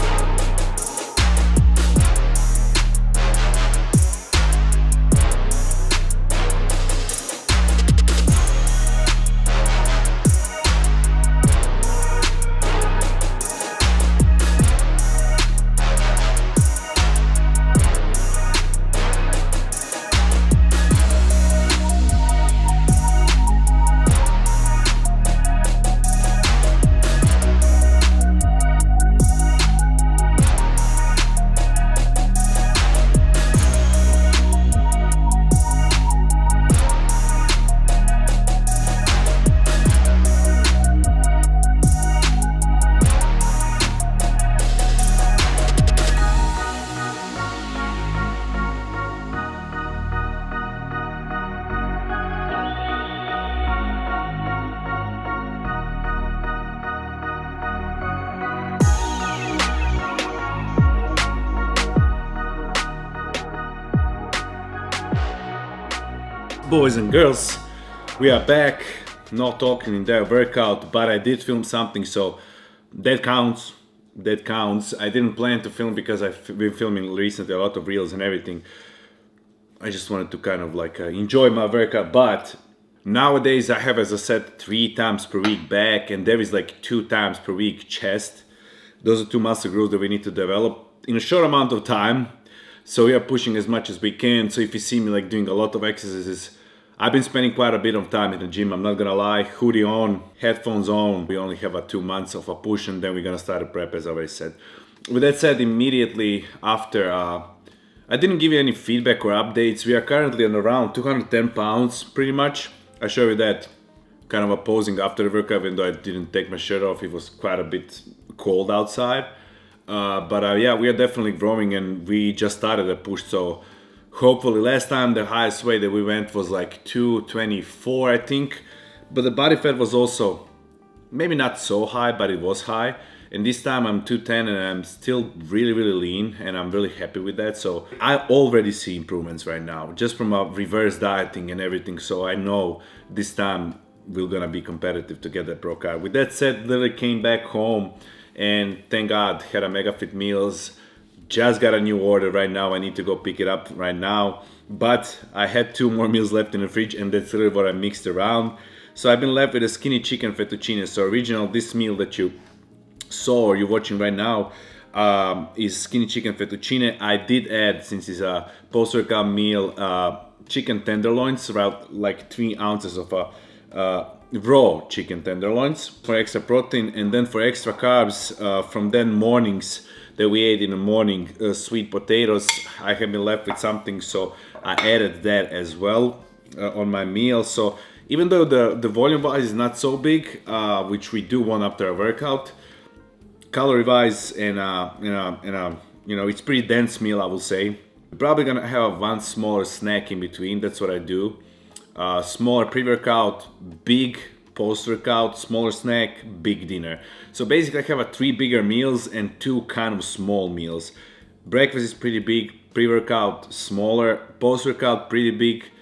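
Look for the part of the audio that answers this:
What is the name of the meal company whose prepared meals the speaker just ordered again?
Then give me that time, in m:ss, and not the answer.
2:29.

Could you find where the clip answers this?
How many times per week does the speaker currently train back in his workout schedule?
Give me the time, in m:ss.
1:24.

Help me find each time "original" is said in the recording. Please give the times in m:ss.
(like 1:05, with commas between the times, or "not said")
2:41.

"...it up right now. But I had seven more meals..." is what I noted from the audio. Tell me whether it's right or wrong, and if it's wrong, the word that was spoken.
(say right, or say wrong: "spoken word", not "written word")
wrong: "two", not "seven".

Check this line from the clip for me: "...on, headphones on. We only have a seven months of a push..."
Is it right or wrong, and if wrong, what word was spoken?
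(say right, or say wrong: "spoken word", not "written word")
wrong: "two", not "seven".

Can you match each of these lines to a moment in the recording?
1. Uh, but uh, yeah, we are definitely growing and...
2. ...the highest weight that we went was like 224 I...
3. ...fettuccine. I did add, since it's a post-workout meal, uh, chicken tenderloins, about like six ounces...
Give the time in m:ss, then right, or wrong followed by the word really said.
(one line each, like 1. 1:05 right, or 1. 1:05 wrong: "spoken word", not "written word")
1. 1:59 right
2. 2:05 right
3. 2:46 wrong: "three", not "six".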